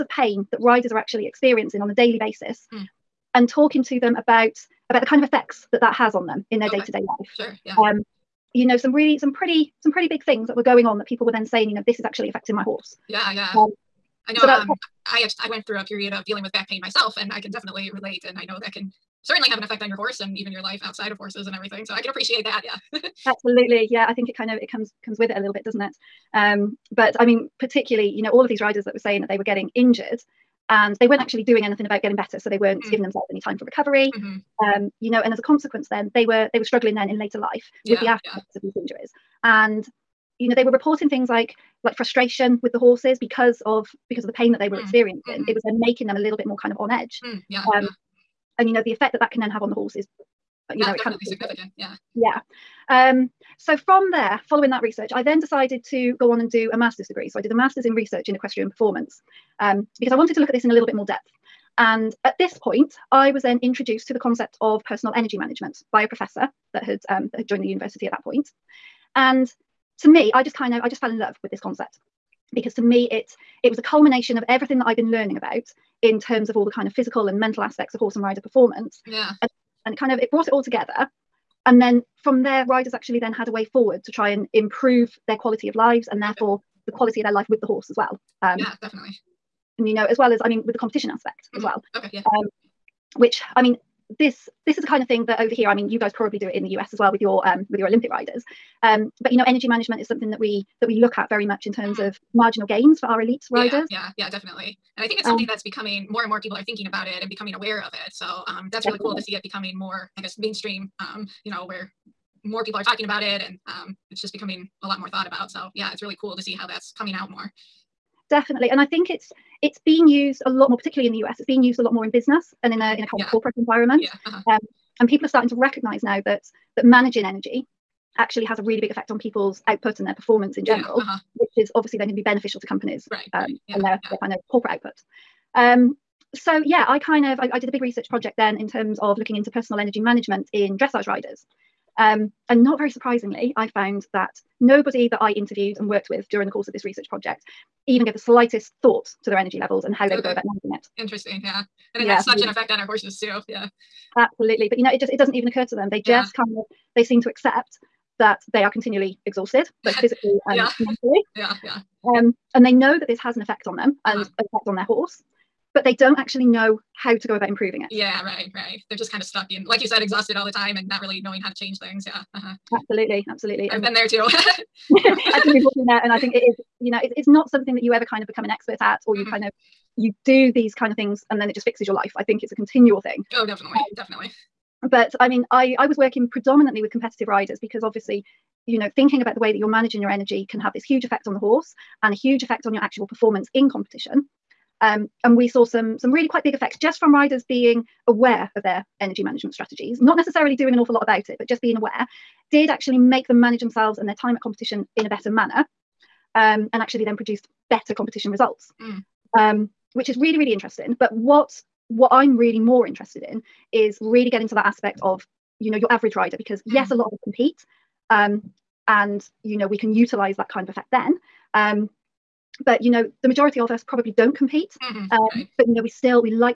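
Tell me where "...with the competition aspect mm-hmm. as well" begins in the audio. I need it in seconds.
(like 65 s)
90 s.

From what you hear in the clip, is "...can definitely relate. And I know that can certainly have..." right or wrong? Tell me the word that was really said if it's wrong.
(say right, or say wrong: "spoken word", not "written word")
right.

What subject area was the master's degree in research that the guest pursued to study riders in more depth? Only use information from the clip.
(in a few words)
Equestrian performance.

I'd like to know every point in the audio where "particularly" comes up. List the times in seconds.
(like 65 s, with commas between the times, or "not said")
27 s, 120 s.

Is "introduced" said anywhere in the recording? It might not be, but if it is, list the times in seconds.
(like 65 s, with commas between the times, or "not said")
63 s.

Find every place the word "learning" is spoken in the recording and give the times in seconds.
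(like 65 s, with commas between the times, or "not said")
75 s.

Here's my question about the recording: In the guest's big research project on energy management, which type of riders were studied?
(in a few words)
Dressage riders.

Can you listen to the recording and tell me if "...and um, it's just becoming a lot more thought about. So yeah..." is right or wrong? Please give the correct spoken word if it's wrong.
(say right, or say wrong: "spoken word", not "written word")
right.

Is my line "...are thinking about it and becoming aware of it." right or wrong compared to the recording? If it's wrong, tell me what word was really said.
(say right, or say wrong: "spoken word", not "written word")
right.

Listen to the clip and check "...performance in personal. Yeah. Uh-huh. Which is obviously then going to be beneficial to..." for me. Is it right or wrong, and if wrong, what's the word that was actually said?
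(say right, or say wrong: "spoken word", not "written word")
wrong: "general", not "personal".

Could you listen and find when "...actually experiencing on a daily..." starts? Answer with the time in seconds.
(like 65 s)
0 s.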